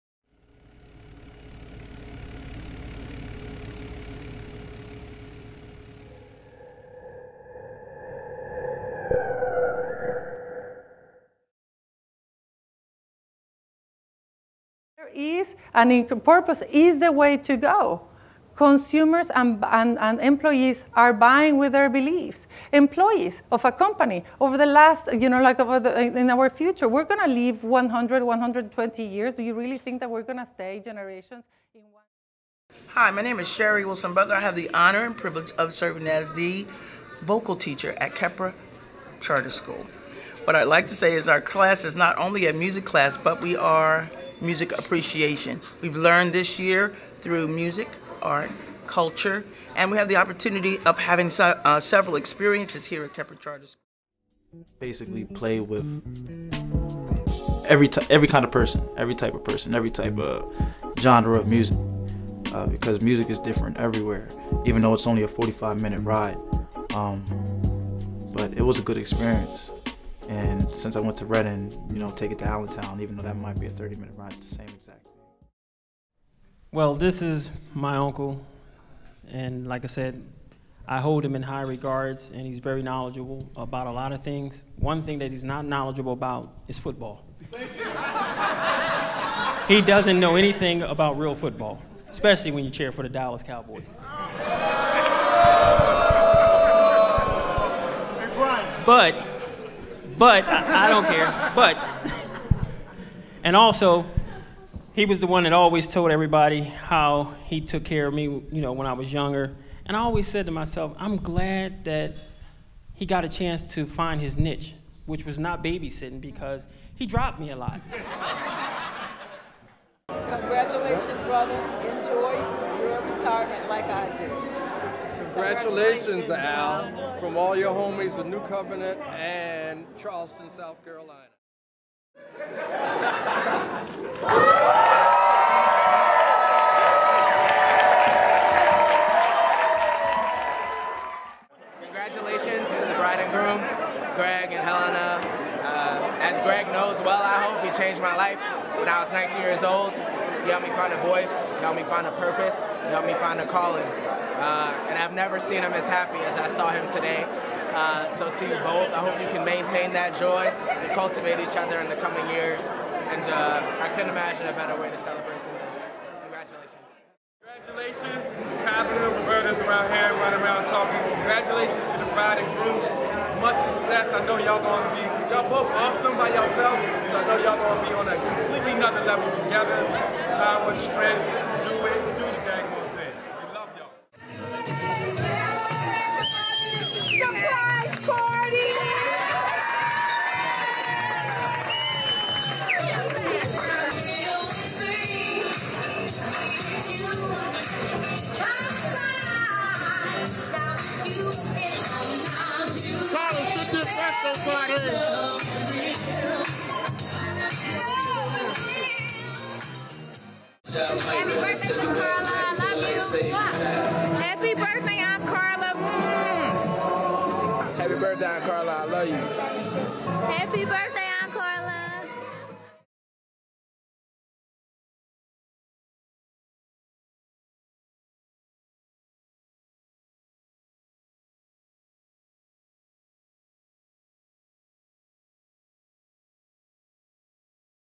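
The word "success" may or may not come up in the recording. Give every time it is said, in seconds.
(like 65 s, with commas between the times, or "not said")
173 s.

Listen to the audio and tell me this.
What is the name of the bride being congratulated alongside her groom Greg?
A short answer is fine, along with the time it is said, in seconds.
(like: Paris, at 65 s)
Helena, at 144 s.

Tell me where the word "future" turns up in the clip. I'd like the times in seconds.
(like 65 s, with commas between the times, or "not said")
26 s.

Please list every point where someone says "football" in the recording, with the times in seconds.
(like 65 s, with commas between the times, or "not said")
86 s, 91 s.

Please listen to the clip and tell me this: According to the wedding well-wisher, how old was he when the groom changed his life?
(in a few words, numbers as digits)
19.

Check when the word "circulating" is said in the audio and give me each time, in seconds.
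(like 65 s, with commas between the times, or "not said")
not said.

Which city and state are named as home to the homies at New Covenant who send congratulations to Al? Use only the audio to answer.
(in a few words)
Charleston, South Carolina.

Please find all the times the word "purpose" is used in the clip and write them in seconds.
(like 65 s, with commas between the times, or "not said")
16 s, 152 s.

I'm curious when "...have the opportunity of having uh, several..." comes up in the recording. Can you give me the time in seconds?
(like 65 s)
49 s.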